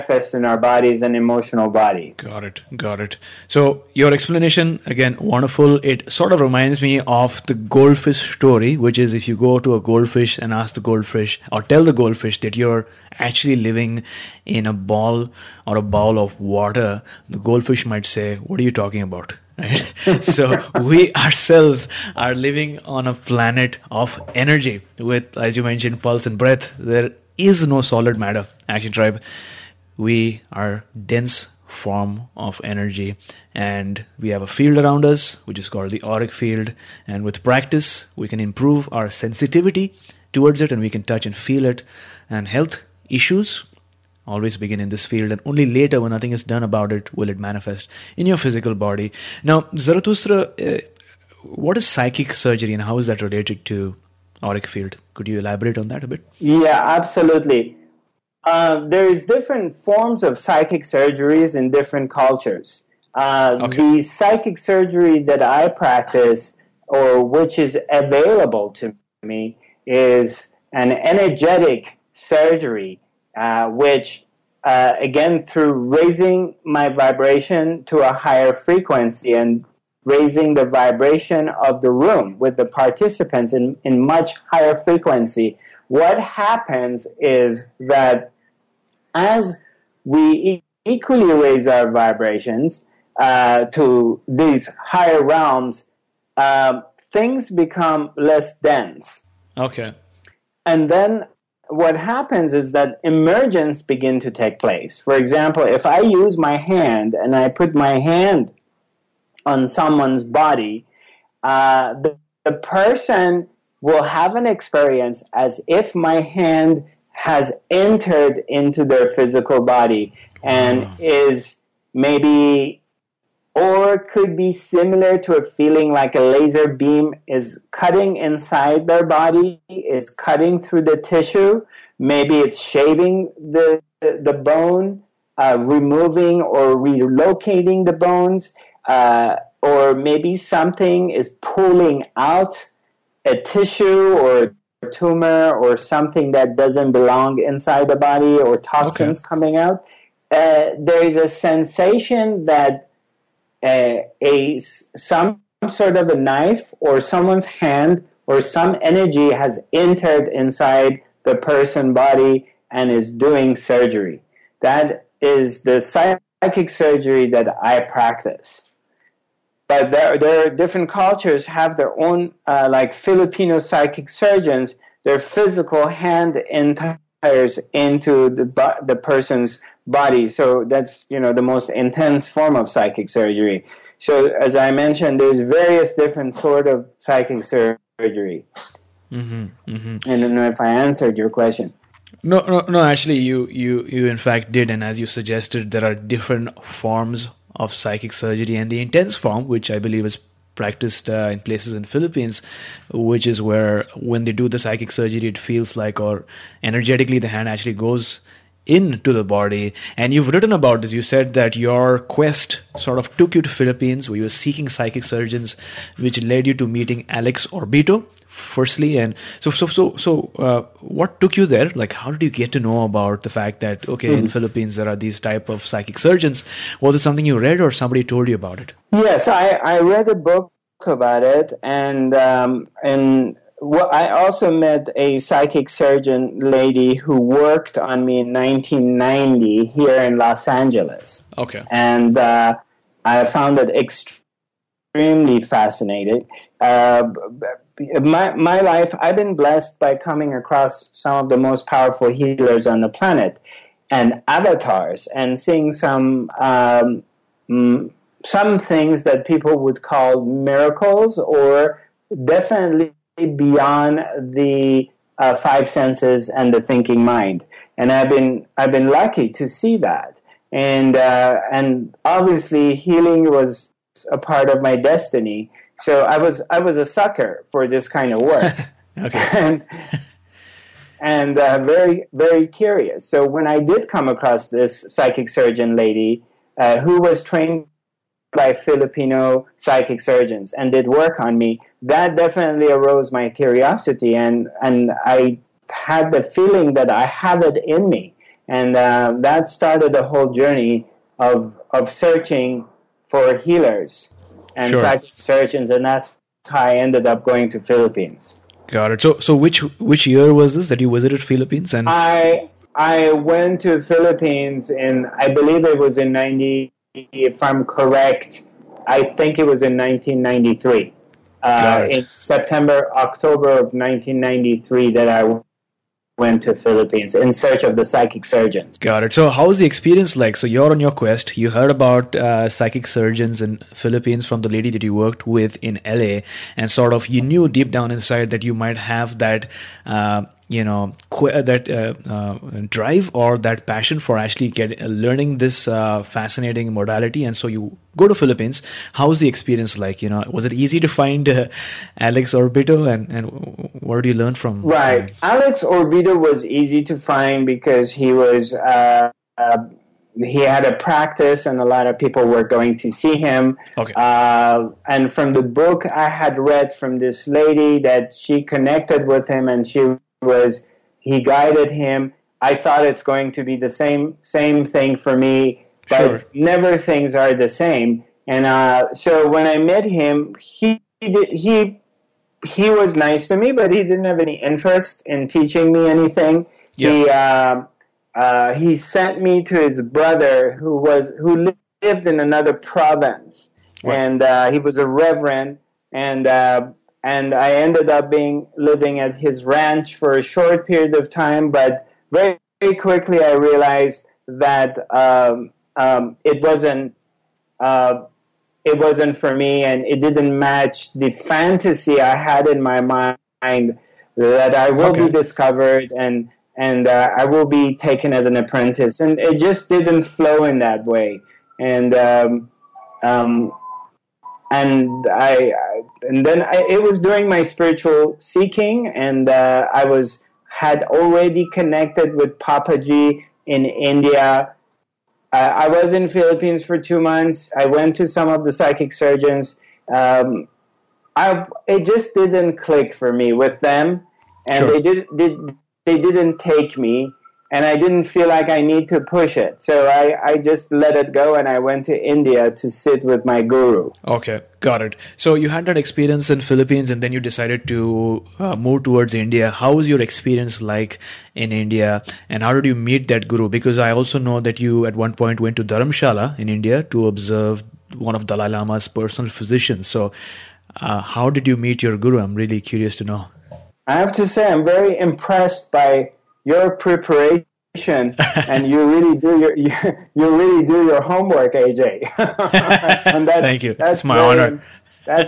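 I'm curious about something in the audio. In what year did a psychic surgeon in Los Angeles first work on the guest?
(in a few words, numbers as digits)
1990.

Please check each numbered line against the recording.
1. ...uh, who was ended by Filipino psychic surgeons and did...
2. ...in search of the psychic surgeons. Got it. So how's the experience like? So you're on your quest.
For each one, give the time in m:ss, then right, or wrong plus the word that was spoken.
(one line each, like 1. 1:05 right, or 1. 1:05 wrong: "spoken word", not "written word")
1. 4:46 wrong: "trained", not "ended"
2. 5:27 right.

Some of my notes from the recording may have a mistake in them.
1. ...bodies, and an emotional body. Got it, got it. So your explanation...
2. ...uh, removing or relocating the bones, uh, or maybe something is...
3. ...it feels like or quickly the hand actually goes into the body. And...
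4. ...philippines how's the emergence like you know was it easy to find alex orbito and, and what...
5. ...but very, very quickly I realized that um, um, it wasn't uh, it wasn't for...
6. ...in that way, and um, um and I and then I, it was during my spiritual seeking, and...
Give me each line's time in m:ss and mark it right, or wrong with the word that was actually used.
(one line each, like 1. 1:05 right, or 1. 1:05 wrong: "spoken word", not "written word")
1. 0:00 right
2. 2:15 right
3. 3:25 wrong: "energetically", not "quickly"
4. 5:48 wrong: "experience", not "emergence"
5. 6:41 right
6. 7:00 right.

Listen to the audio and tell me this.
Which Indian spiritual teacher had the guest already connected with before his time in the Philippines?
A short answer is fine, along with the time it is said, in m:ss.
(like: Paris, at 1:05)
Papaji, at 7:12.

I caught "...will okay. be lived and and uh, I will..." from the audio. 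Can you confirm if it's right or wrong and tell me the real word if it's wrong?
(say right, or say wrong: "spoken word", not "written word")
wrong: "discovered", not "lived".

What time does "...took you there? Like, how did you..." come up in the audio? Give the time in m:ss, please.
3:41.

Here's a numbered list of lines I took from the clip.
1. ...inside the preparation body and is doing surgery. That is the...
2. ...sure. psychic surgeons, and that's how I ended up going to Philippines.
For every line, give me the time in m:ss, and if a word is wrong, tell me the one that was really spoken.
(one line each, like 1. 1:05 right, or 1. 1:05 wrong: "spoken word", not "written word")
1. 2:40 wrong: "person", not "preparation"
2. 5:04 right.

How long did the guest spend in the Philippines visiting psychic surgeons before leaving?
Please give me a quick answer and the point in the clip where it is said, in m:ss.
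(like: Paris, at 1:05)
two months, at 7:16.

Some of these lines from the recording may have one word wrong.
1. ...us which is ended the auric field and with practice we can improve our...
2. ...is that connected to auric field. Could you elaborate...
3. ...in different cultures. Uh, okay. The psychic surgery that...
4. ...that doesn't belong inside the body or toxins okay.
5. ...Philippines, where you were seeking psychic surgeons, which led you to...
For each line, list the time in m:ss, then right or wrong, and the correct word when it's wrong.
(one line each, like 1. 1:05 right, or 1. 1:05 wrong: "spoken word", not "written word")
1. 0:35 wrong: "called", not "ended"
2. 0:52 wrong: "related", not "connected"
3. 1:01 right
4. 2:26 right
5. 3:33 right.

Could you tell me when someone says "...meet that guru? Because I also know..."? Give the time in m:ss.
7:42.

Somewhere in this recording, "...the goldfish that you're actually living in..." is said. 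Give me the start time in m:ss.
0:11.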